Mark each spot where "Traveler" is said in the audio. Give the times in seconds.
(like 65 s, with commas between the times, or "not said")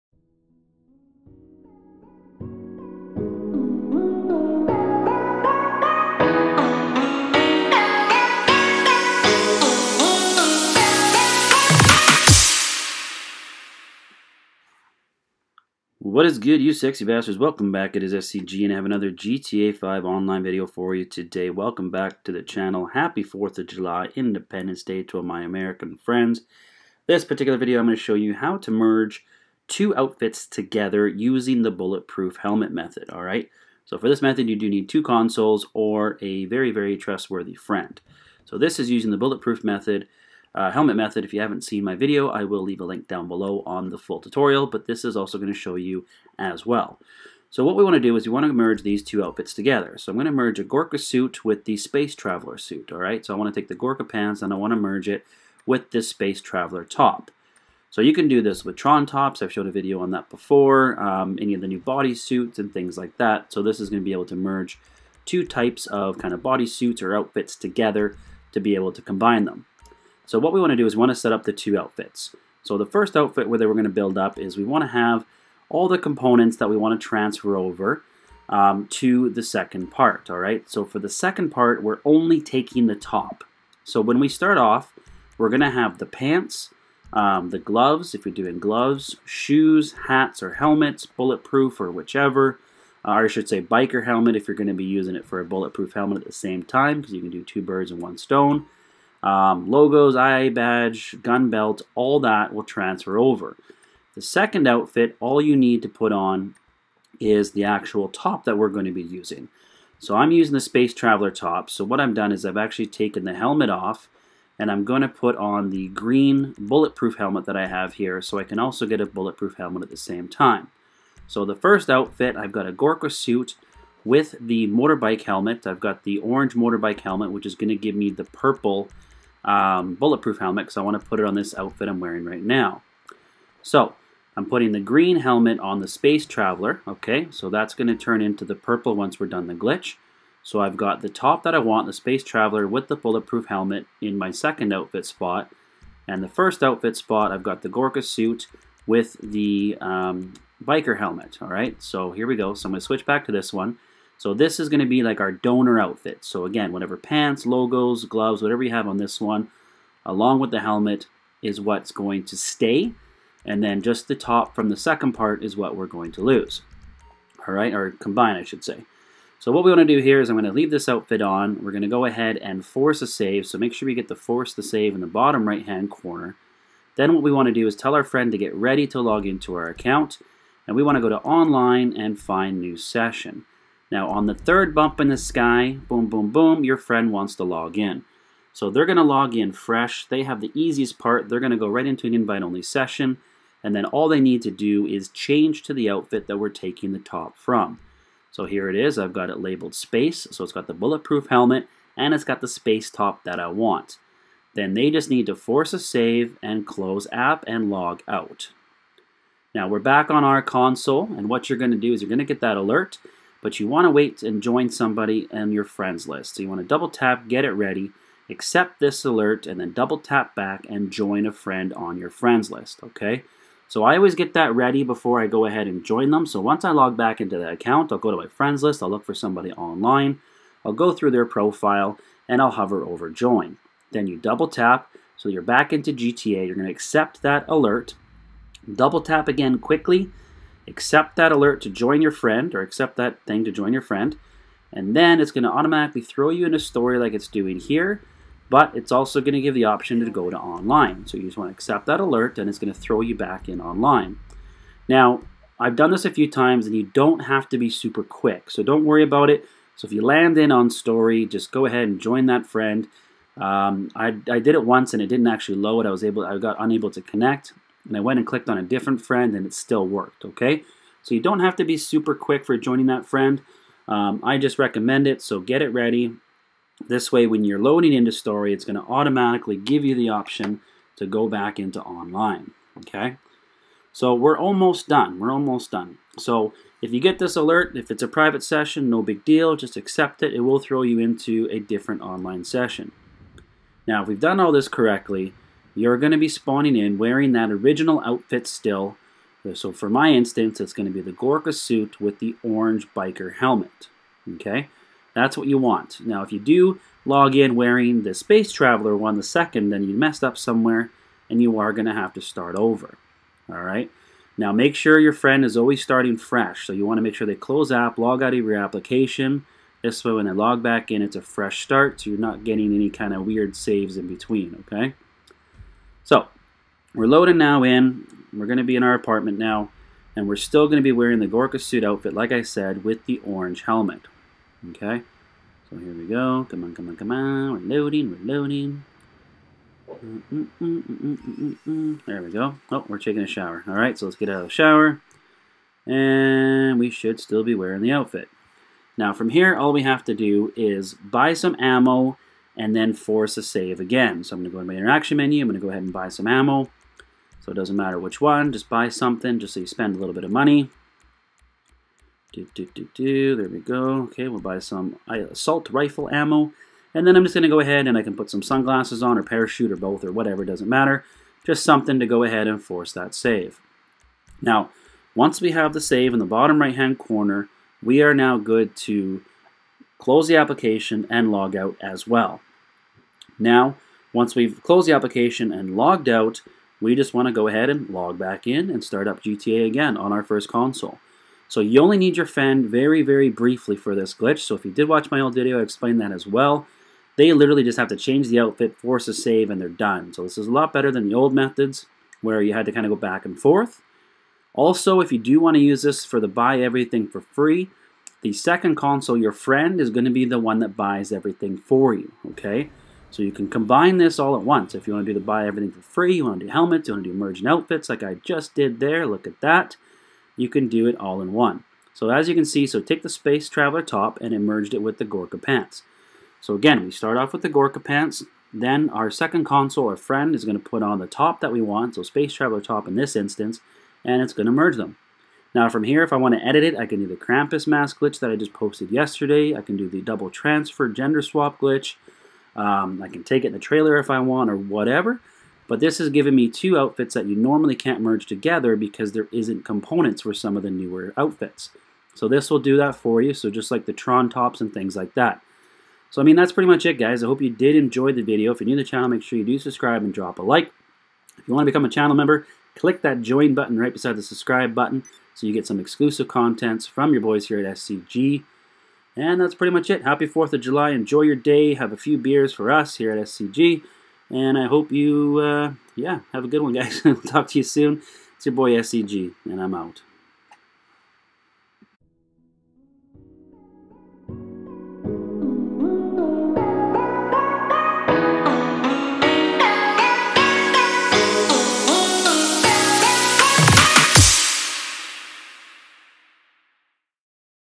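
52 s, 56 s, 110 s, 136 s, 142 s, 308 s, 423 s, 432 s.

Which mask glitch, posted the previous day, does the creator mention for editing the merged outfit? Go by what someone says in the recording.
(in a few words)
Krampus mask glitch.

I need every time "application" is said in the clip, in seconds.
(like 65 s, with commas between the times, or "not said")
318 s, 380 s, 384 s.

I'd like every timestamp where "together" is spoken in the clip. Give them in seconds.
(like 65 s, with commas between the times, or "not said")
30 s, 49 s, 67 s, 448 s.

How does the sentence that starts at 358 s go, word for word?
Just buy something just so you spend a little bit of money.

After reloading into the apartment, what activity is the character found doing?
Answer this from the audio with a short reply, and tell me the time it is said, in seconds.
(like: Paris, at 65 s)
Taking a shower, at 342 s.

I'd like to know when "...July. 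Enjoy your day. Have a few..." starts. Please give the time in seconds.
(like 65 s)
470 s.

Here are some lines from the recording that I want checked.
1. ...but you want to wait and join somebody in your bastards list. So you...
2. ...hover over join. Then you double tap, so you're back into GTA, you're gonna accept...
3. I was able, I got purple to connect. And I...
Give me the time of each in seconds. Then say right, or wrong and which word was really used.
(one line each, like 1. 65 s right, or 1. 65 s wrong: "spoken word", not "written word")
1. 213 s wrong: "friends", not "bastards"
2. 232 s right
3. 265 s wrong: "unable", not "purple".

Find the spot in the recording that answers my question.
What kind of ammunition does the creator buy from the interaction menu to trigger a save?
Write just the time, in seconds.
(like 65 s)
365 s.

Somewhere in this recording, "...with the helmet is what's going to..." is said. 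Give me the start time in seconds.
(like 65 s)
160 s.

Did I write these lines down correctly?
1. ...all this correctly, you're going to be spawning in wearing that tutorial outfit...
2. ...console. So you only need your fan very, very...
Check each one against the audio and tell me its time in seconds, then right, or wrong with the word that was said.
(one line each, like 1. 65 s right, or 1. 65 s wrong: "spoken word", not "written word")
1. 294 s wrong: "original", not "tutorial"
2. 390 s right.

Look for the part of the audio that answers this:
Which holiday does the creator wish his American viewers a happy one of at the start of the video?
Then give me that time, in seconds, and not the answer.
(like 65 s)
24 s.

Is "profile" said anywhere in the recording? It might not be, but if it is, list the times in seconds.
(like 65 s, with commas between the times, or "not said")
231 s.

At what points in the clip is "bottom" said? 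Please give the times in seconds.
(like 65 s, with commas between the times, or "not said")
175 s, 376 s.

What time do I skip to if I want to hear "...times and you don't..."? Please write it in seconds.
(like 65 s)
256 s.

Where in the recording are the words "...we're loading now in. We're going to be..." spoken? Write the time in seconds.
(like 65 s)
326 s.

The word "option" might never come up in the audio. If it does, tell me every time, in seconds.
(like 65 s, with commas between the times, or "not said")
249 s, 280 s.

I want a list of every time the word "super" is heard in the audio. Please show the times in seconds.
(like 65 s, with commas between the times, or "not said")
257 s, 271 s.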